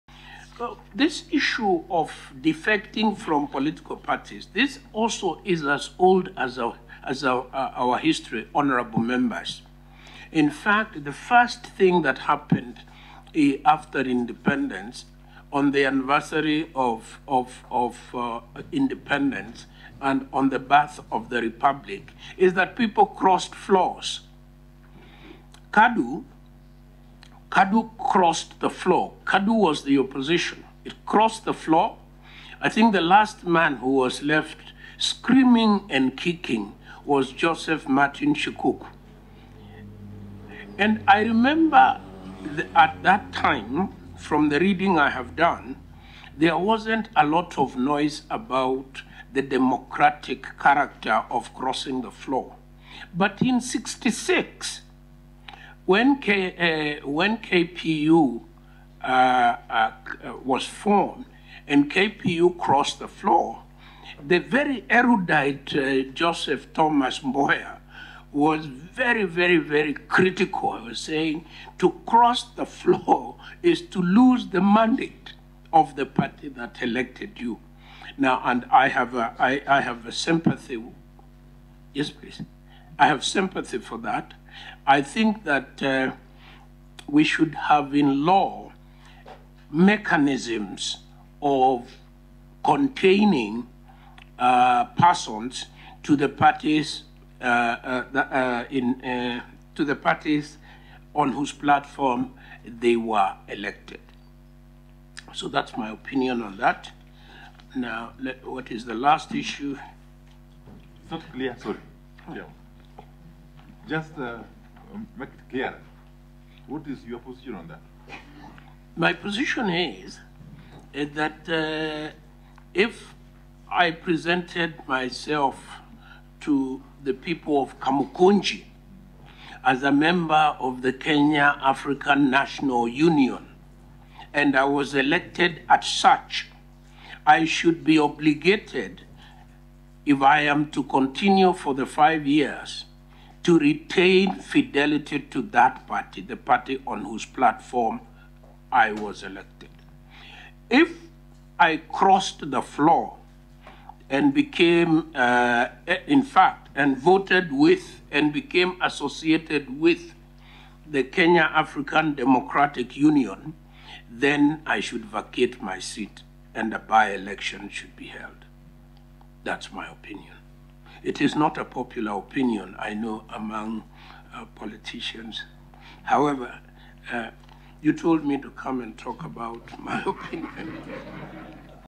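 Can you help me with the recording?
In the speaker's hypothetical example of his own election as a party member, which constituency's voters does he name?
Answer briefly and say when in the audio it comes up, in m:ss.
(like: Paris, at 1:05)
Kamukunji, at 2:07.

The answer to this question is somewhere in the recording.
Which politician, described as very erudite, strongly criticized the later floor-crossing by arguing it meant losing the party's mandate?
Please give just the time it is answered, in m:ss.
1:06.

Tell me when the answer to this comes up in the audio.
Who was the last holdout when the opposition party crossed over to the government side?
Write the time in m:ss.
0:37.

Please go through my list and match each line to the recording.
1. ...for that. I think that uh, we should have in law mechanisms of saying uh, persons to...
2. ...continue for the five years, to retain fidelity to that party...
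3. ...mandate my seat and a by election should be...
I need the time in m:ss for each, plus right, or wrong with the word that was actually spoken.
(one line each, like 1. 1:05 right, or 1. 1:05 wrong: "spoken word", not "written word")
1. 1:23 wrong: "containing", not "saying"
2. 2:20 right
3. 2:45 wrong: "vacate", not "mandate".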